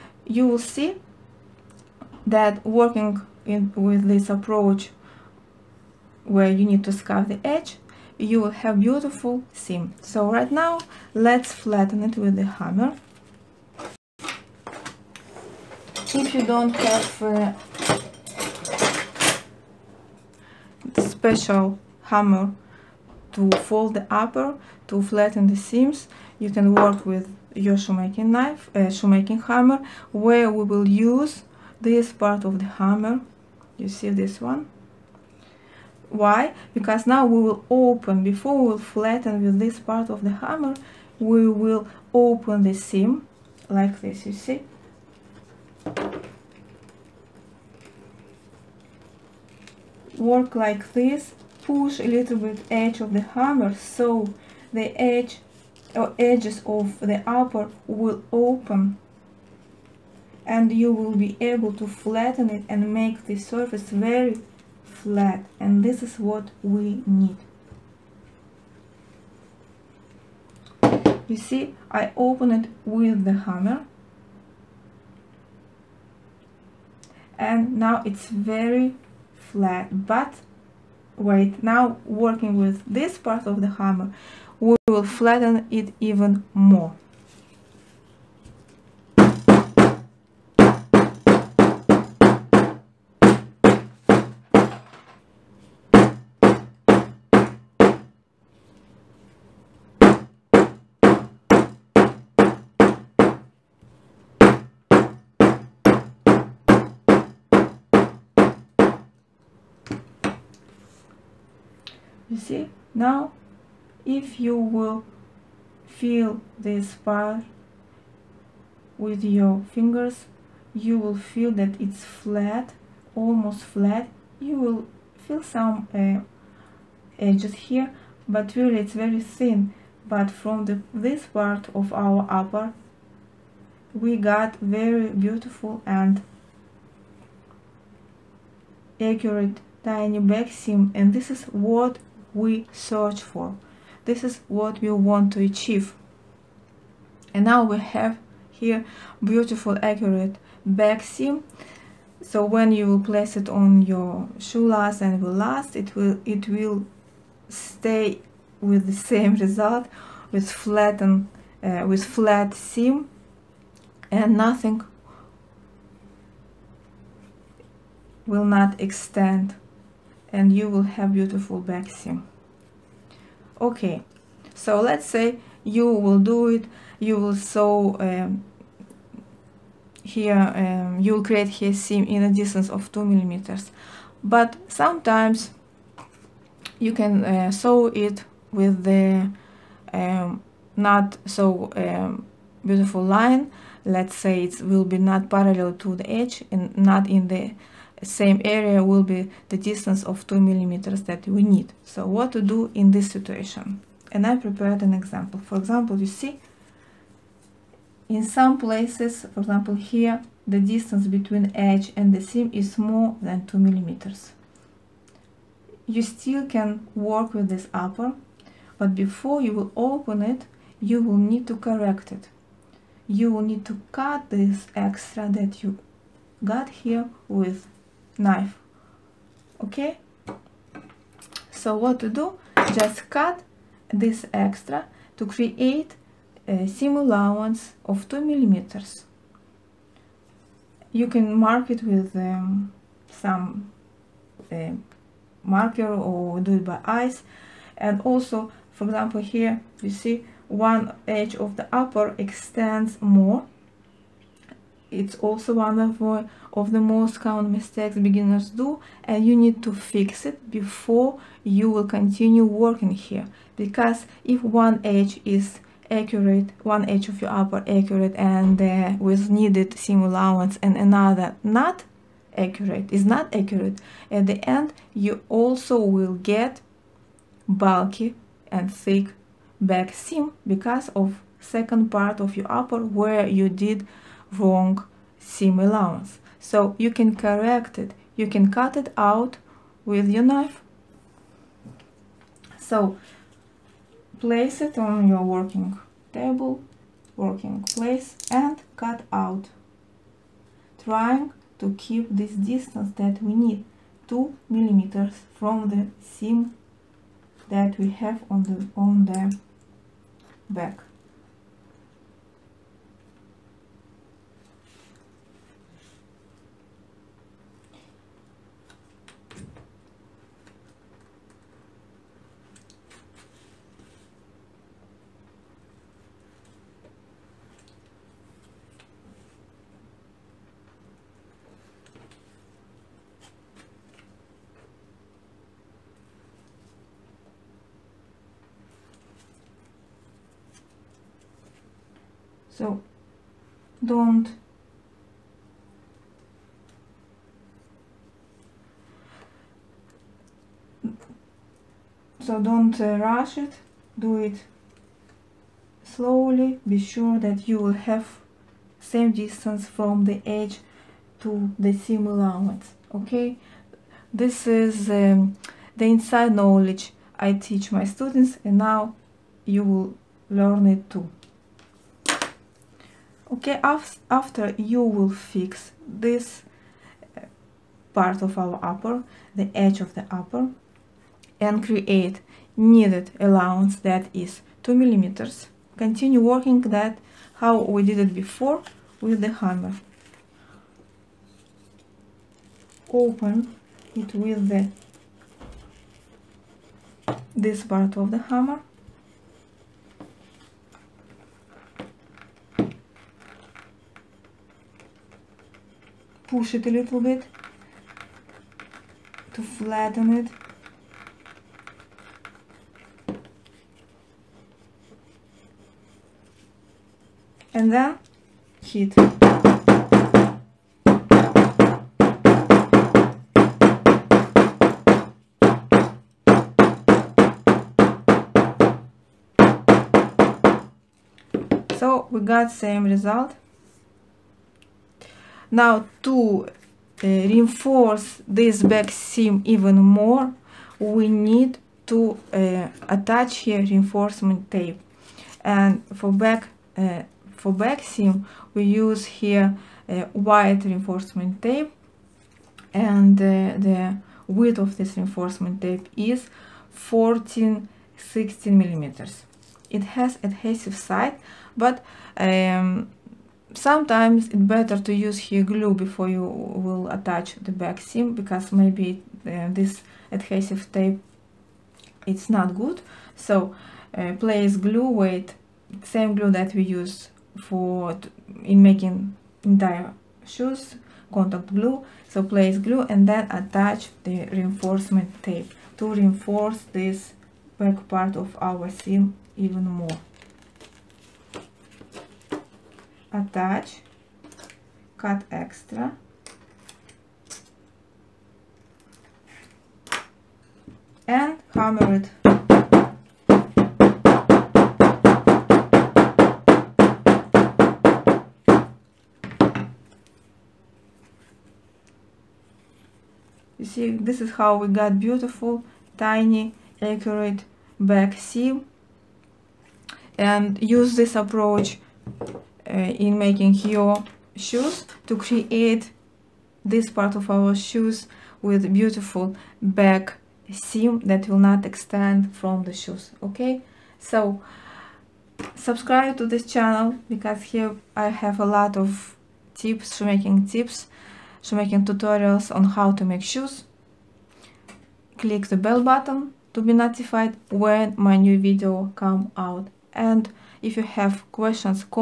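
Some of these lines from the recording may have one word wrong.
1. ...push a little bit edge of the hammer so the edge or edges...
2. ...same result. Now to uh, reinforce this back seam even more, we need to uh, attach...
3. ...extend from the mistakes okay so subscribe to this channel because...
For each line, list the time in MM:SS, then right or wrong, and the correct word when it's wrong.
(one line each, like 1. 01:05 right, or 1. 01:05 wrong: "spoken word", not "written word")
1. 00:51 right
2. 07:12 right
3. 08:51 wrong: "shoes", not "mistakes".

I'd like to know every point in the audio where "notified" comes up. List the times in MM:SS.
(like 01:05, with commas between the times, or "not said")
09:06.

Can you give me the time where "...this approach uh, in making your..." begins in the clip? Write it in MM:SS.
08:40.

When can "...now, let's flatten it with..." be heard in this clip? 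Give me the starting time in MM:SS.
00:10.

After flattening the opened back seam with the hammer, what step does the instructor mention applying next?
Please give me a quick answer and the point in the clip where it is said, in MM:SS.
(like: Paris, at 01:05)
heat, at 06:58.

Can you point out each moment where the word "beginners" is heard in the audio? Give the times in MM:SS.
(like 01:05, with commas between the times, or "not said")
04:17.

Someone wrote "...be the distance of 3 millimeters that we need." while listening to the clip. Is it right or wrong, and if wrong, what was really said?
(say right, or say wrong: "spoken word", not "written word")
wrong: "2", not "3".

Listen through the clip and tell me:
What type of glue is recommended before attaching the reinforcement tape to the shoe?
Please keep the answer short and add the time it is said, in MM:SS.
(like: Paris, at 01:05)
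contact glue, at 08:01.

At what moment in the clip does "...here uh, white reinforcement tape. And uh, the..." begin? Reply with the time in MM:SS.
07:29.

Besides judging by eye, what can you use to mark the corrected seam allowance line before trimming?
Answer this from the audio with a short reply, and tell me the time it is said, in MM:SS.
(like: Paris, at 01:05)
marker, at 04:05.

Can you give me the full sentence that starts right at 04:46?
So you can correct it, you can cut it out with your knife.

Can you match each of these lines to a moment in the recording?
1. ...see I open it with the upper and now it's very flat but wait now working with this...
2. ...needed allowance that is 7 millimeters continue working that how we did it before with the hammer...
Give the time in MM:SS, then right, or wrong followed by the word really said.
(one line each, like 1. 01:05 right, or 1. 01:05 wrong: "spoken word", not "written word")
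1. 01:11 wrong: "hammer", not "upper"
2. 06:22 wrong: "2", not "7".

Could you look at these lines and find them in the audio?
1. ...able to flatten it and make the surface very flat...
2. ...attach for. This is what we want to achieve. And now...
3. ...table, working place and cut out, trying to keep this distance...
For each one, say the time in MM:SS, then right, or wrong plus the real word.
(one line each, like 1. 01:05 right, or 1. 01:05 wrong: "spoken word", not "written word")
1. 01:01 right
2. 02:22 wrong: "search", not "attach"
3. 04:56 right.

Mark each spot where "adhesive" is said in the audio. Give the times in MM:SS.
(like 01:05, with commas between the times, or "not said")
07:40, 07:50.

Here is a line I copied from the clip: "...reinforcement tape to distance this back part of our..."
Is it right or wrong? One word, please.
wrong.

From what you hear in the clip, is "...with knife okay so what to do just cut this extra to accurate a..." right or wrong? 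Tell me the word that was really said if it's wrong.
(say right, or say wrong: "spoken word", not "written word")
wrong: "create", not "accurate".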